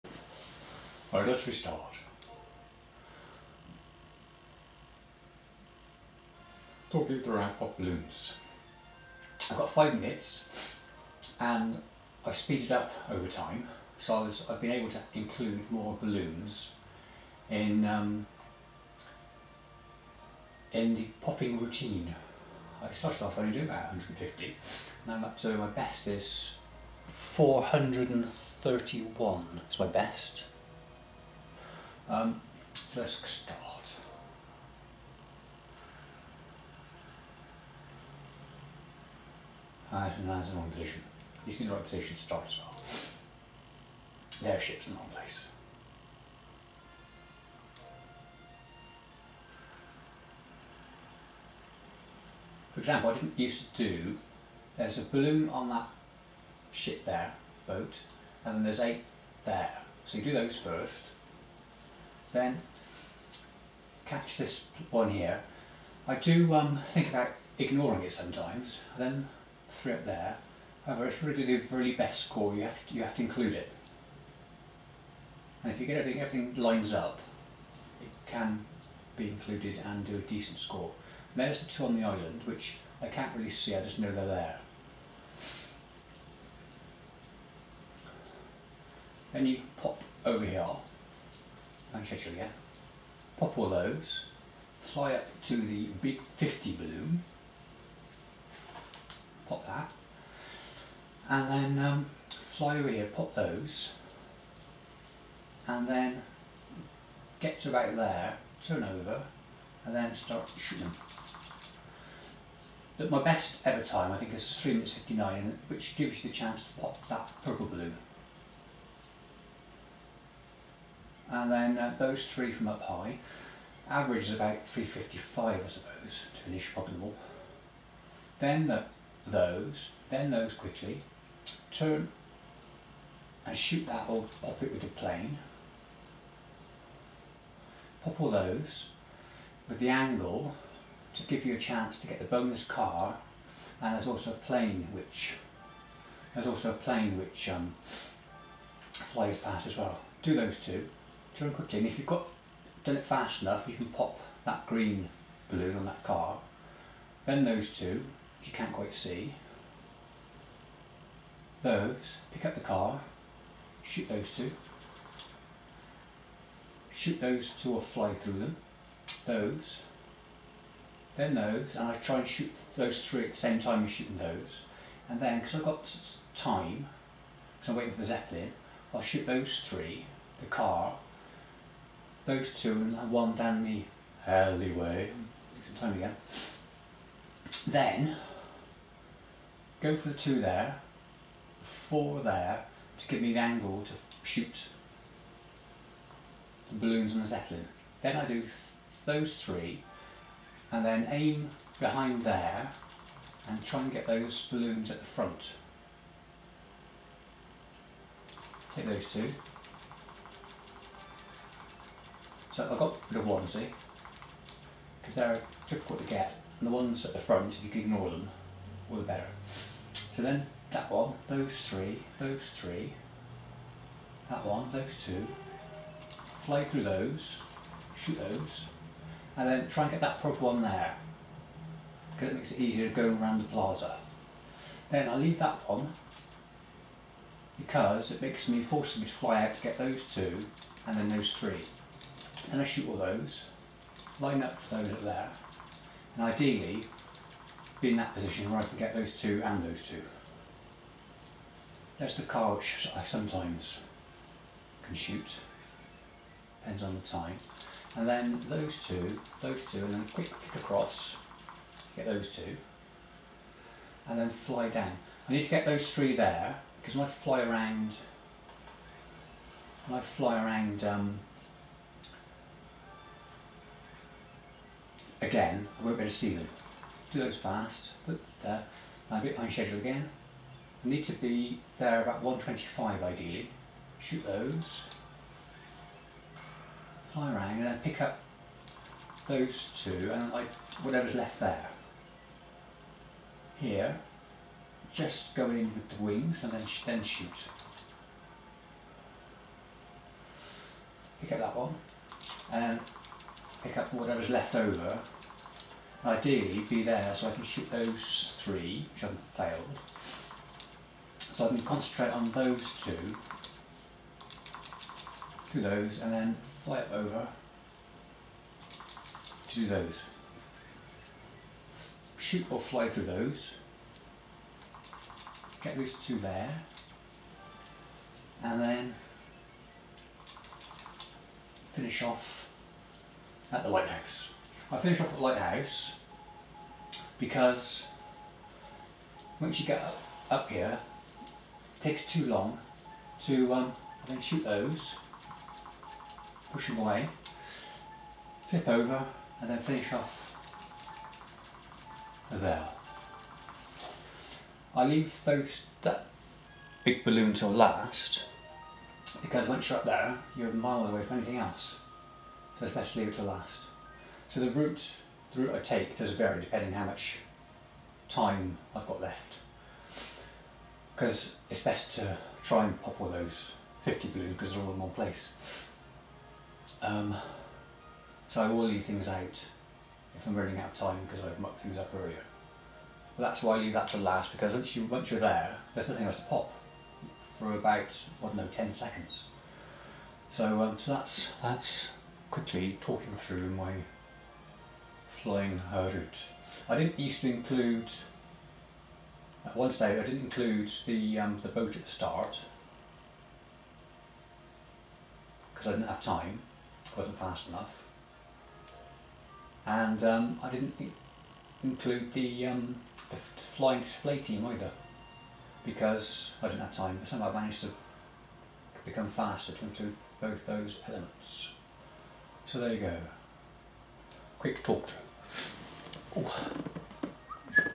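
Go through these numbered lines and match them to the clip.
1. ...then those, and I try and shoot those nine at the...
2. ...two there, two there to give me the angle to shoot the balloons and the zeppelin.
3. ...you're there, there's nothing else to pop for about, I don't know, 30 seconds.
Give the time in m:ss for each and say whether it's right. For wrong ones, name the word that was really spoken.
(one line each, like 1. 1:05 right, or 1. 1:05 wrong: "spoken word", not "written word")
1. 2:51 wrong: "three", not "nine"
2. 3:10 wrong: "four", not "two"
3. 6:25 wrong: "10", not "30".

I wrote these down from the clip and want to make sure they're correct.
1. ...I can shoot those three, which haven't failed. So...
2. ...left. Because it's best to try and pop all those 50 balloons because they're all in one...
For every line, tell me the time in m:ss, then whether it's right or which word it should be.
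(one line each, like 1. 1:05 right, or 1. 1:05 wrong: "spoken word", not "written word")
1. 5:07 right
2. 6:09 right.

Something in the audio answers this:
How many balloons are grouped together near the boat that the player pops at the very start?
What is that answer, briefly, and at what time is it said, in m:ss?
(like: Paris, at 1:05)
8, at 0:58.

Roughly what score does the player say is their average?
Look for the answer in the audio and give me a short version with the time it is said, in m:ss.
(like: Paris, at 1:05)
355, at 2:04.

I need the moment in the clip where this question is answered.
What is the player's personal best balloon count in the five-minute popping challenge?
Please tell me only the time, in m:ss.
0:27.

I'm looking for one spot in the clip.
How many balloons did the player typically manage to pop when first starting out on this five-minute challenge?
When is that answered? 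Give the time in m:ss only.
0:23.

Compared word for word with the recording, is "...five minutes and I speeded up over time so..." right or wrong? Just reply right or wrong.
right.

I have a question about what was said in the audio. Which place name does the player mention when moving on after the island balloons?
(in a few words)
Manchester.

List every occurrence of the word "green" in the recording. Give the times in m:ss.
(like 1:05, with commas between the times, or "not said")
2:34.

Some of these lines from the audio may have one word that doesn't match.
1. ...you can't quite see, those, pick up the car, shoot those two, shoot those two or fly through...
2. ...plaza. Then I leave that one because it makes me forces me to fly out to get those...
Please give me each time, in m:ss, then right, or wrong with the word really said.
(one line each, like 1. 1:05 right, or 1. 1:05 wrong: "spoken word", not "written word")
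1. 2:38 right
2. 3:53 right.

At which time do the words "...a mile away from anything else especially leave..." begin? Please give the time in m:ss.
6:00.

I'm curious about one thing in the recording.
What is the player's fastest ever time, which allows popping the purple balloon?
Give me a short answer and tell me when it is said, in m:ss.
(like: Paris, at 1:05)
3 minutes 59, at 1:54.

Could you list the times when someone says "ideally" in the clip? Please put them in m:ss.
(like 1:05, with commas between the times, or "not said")
4:06, 4:43, 5:06.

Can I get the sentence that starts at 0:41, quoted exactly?
He's in the right position to start as well.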